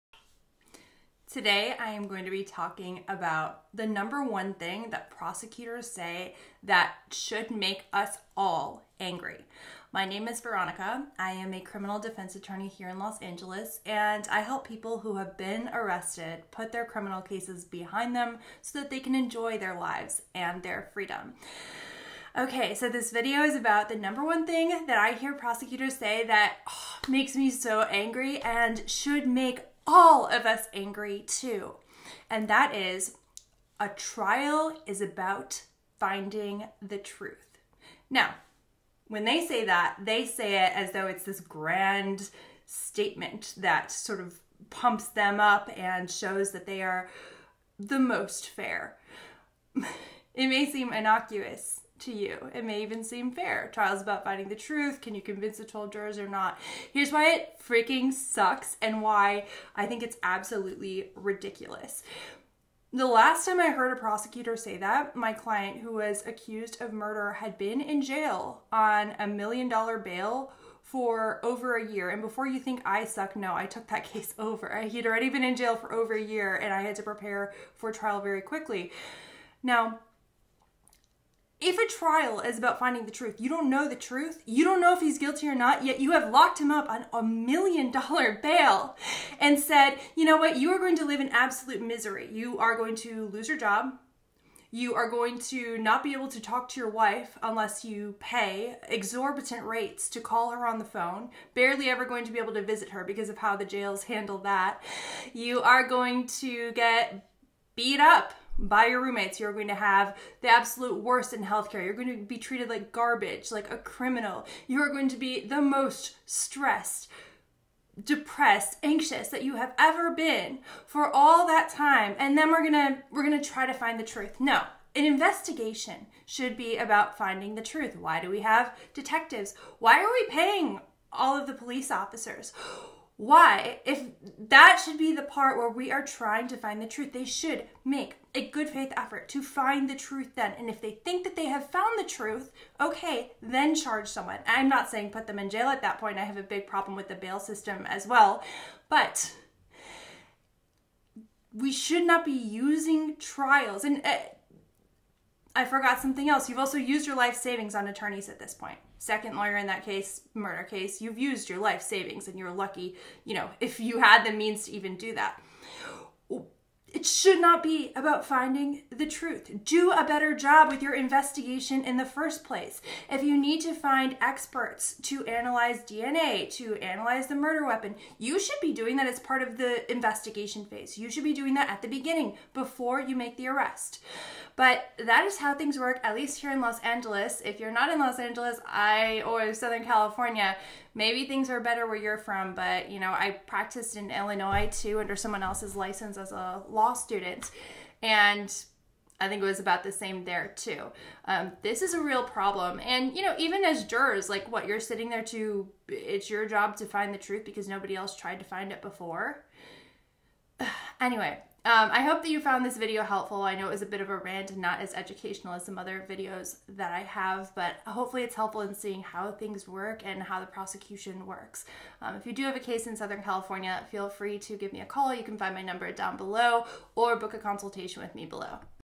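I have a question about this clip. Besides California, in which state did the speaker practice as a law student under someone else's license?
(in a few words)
Illinois.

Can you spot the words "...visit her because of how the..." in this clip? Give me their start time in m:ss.
1:42.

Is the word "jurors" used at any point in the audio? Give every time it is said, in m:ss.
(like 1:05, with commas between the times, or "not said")
0:55, 3:23.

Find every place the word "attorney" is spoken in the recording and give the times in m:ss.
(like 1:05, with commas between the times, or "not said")
0:12, 2:37.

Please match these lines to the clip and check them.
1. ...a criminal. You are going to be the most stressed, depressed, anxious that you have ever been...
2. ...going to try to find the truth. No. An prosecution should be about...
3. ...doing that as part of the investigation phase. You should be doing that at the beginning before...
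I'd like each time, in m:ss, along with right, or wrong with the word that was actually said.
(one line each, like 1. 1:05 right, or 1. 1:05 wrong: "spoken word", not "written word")
1. 1:53 right
2. 2:03 wrong: "investigation", not "prosecution"
3. 2:58 right.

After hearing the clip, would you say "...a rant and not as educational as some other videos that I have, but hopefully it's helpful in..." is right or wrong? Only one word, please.
right.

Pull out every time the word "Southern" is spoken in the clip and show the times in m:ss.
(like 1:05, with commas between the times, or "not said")
3:09, 3:42.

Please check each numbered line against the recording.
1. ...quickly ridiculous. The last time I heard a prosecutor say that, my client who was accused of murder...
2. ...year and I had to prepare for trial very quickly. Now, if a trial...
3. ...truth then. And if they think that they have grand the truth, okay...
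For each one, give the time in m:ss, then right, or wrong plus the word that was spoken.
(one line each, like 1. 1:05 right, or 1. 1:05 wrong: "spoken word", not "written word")
1. 1:00 wrong: "absolutely", not "quickly"
2. 1:16 right
3. 2:19 wrong: "found", not "grand".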